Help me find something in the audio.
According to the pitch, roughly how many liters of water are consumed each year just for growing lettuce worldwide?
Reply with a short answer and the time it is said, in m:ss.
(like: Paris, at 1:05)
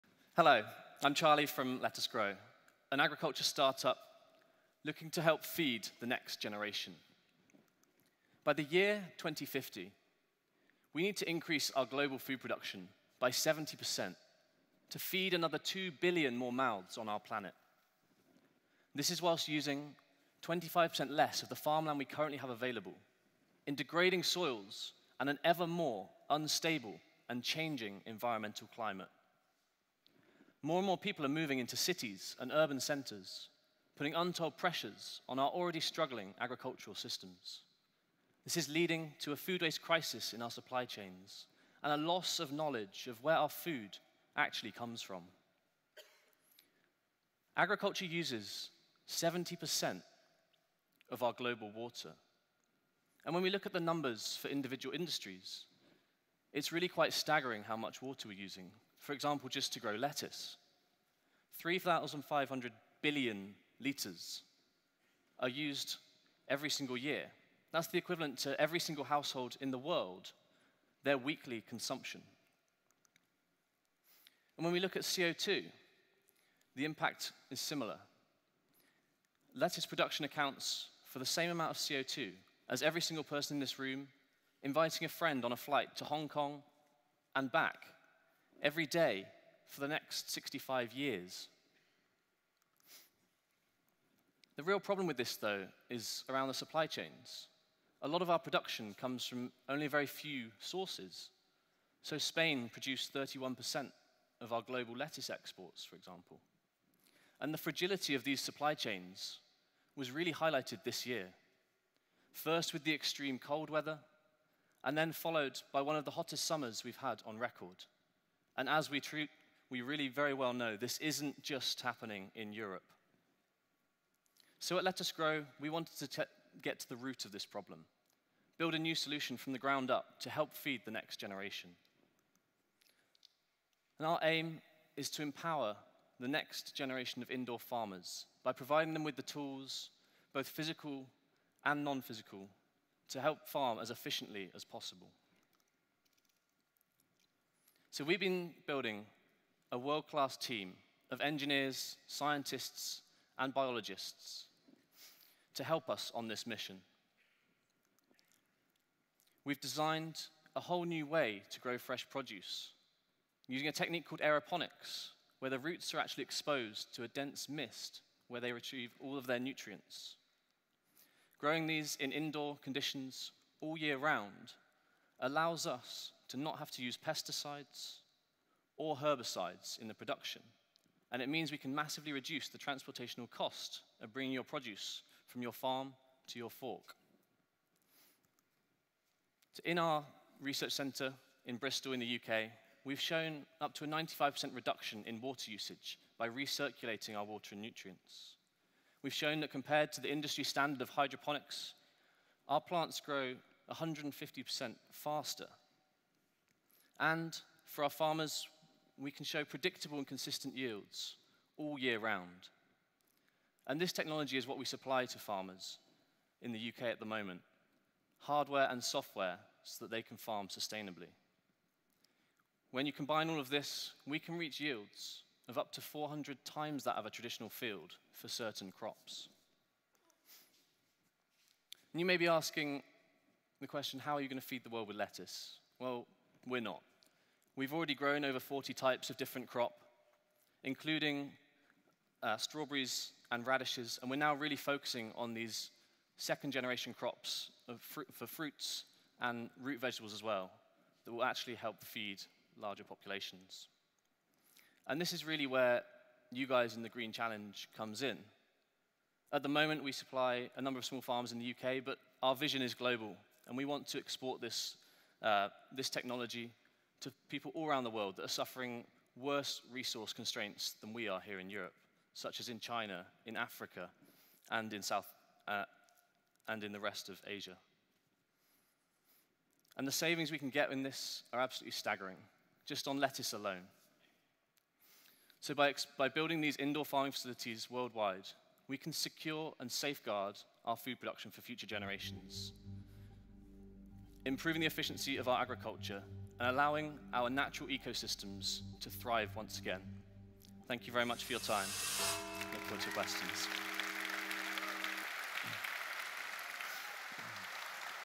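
3,500 billion liters, at 1:01.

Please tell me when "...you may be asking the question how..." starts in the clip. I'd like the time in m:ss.
3:51.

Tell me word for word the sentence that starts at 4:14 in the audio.
And this is really where you guys in the Green Challenge comes in.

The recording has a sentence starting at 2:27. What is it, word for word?
So we've been building a world-class team of engineers, scientists, and biologists to help us on this mission.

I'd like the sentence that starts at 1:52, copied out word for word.
First with the extreme cold weather, and then followed by one of the hottest summers we've had on record.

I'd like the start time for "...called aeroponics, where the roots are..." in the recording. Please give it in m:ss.
2:44.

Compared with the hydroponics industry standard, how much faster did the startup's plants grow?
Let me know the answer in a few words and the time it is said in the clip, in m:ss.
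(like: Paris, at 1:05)
150%, at 3:23.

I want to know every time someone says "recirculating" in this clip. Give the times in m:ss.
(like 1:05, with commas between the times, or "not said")
3:16.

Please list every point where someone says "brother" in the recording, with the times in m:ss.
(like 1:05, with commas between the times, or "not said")
not said.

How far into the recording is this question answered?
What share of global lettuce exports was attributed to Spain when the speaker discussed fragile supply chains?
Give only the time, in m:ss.
1:43.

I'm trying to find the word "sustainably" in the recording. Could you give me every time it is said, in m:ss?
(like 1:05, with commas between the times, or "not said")
3:40.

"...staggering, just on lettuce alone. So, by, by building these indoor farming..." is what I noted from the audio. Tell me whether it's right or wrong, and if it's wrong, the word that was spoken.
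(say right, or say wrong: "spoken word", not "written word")
right.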